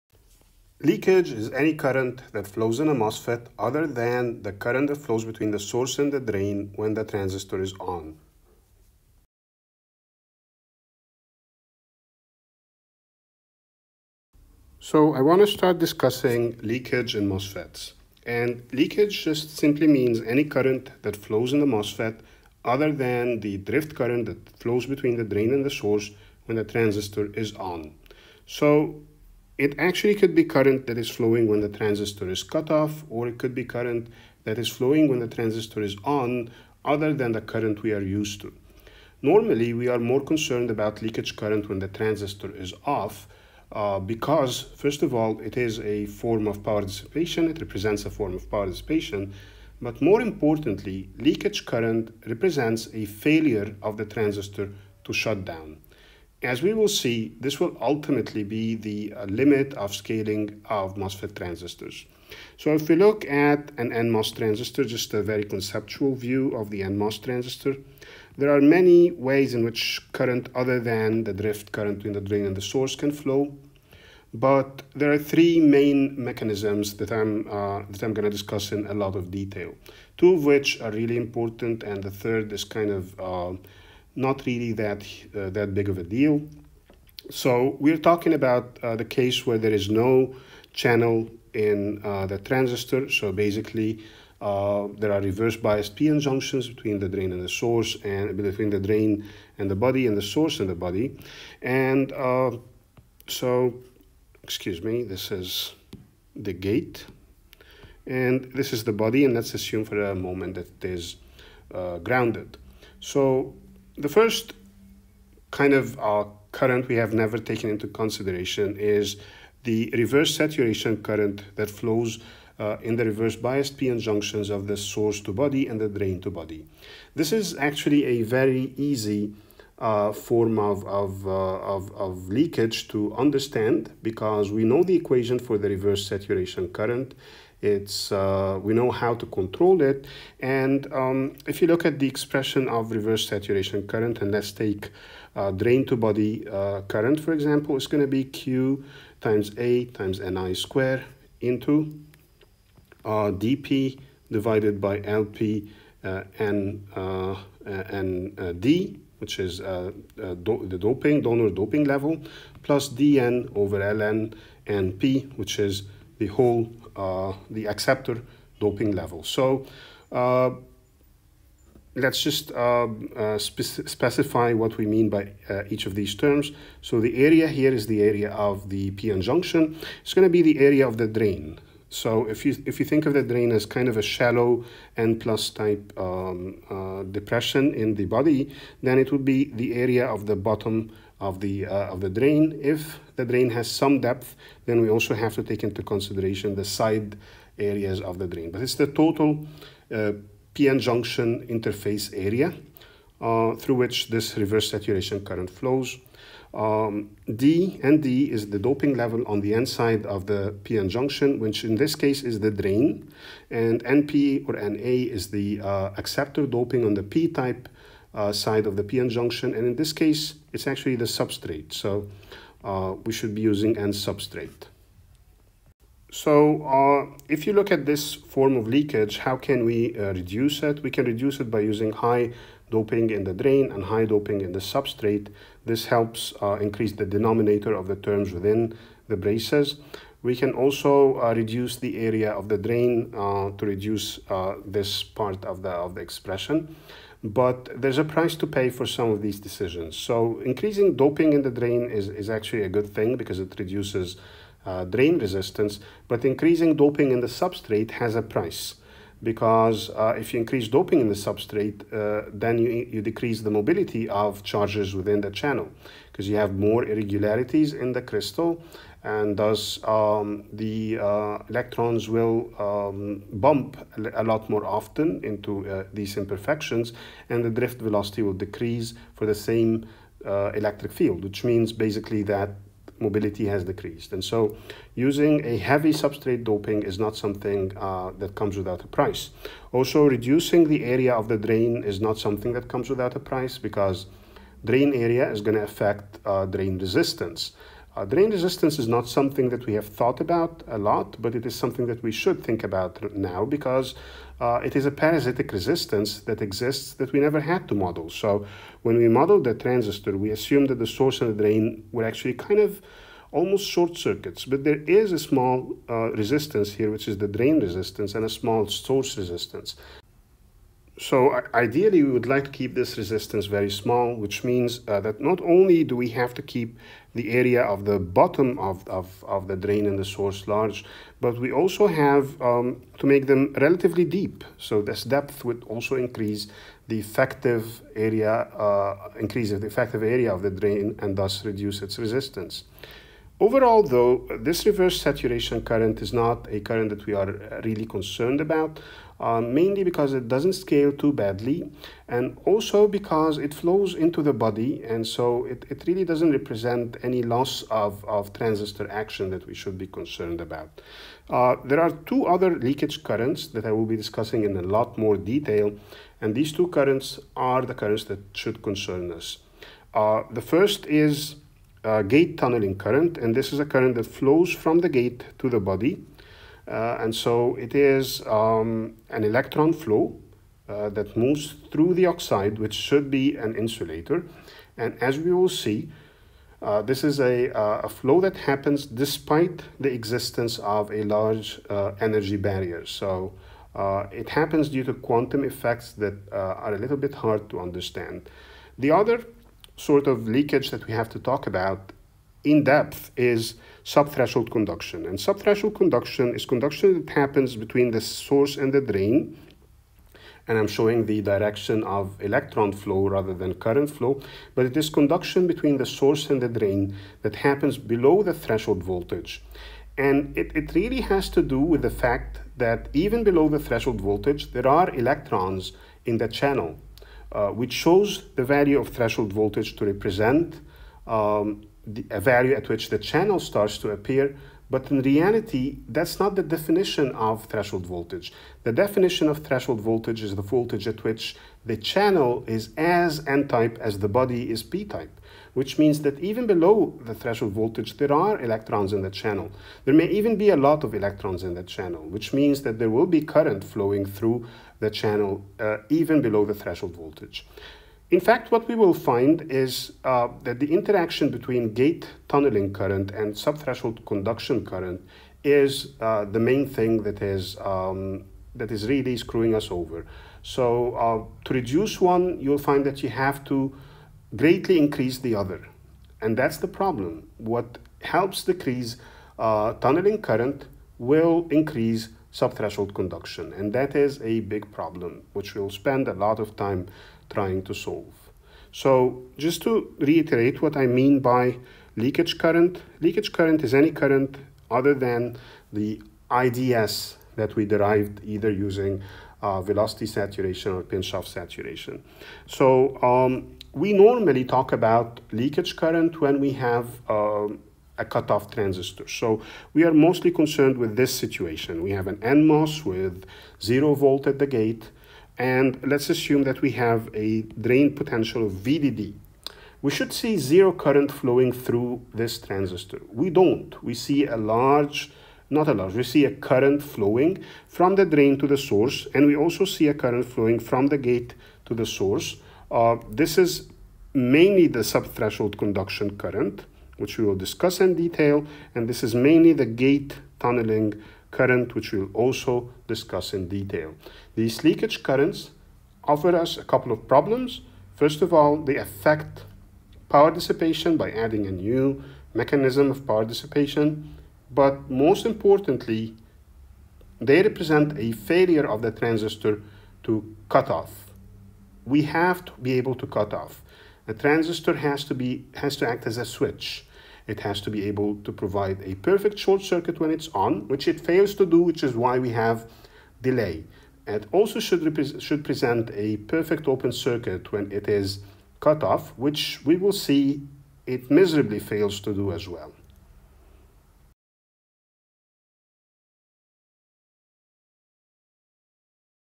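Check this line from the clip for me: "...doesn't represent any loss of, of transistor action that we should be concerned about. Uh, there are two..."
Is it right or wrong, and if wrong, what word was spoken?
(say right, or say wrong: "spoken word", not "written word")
right.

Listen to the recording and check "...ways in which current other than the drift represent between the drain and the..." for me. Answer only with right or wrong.
wrong.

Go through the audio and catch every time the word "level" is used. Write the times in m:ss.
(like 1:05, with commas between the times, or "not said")
2:41, 2:48, 3:28.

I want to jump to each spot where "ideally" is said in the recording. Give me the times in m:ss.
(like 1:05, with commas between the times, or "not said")
5:21.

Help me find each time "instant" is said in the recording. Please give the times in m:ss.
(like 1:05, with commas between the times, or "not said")
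not said.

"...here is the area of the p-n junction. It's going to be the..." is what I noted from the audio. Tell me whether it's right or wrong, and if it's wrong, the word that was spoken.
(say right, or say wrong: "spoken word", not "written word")
right.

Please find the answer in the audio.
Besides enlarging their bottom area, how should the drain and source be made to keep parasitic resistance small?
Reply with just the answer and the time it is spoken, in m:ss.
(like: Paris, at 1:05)
make them relatively deep, at 5:33.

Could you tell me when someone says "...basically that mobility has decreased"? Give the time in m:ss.
4:41.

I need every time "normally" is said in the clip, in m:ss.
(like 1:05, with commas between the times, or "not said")
0:39, 8:23.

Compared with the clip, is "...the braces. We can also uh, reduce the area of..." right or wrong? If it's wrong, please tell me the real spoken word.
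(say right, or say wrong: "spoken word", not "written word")
right.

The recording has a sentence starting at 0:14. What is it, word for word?
So I want to start discussing leakage in MOSFETs.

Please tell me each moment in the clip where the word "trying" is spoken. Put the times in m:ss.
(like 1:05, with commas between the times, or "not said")
8:07.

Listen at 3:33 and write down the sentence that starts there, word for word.
And NP or NA is the uh, acceptor doping on the P-type uh, side of the p-n junction.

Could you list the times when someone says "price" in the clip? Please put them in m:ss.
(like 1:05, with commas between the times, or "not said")
4:08, 4:18, 4:48, 4:53.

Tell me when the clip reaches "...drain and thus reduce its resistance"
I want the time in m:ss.
5:40.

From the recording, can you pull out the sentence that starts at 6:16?
Uh, and so it is um, an electron flow uh, that moves through the oxide, which should be an insulator.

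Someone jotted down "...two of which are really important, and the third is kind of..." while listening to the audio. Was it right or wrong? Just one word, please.
right.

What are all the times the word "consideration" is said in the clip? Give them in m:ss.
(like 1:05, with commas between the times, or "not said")
1:57, 3:15.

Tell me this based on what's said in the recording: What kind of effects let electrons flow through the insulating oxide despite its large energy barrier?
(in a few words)
quantum effects.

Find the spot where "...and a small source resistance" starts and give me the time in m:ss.
5:18.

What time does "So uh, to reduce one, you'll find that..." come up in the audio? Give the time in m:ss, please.
7:50.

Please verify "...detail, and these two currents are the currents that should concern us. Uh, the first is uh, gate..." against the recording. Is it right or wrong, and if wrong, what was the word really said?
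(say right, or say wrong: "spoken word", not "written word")
right.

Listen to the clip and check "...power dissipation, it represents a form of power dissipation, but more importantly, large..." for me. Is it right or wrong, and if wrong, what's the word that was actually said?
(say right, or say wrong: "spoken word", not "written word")
wrong: "leakage", not "large".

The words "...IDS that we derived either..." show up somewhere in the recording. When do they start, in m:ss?
8:16.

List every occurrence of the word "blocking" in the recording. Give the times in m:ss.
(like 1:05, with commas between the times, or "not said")
not said.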